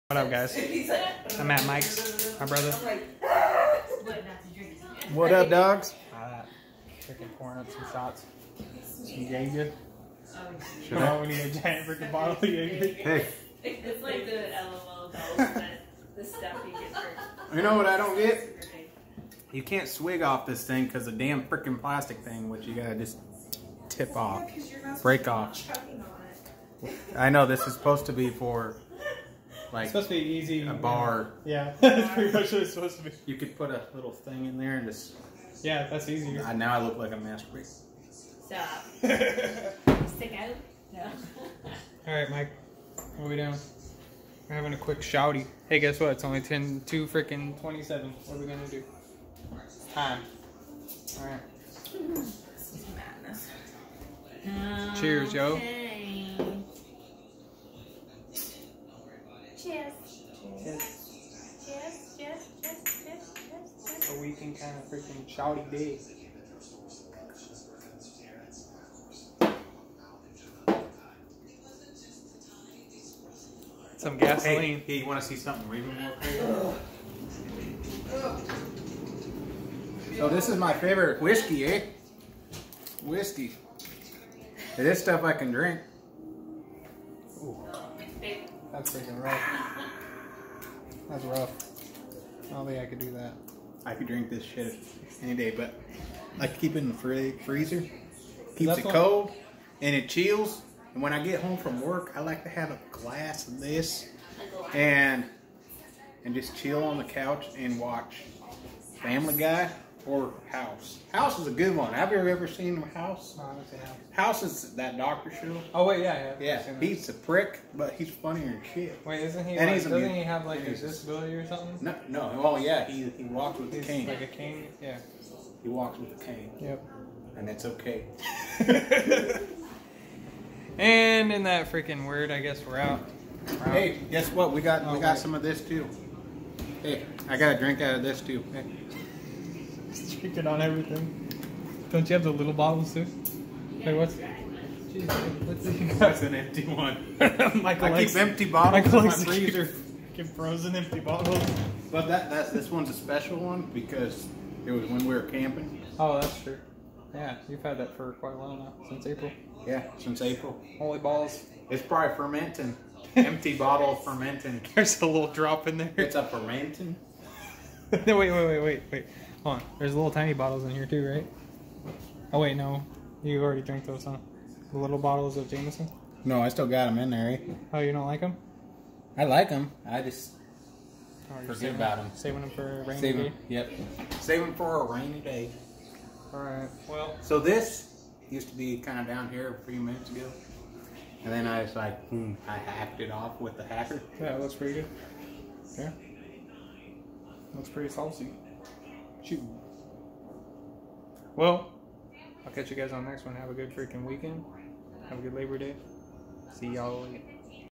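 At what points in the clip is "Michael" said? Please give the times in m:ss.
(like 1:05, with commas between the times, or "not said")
2:27.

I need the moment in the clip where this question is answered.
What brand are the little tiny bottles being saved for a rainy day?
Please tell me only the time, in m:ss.
2:55.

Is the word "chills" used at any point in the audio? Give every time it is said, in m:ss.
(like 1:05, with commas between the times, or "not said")
1:40, 1:46.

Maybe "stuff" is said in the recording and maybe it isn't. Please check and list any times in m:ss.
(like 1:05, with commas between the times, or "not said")
0:16, 1:25.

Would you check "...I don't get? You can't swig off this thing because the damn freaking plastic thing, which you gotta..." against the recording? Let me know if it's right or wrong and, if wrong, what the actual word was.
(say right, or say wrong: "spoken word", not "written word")
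right.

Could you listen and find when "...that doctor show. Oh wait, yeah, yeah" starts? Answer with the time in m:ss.
1:54.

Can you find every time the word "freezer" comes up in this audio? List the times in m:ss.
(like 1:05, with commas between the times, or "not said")
1:37, 2:29.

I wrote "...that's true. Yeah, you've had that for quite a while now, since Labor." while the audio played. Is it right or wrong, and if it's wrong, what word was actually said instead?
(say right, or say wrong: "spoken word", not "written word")
wrong: "April", not "Labor".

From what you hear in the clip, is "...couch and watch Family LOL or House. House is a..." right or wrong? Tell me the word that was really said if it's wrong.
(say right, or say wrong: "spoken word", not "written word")
wrong: "Guy", not "LOL".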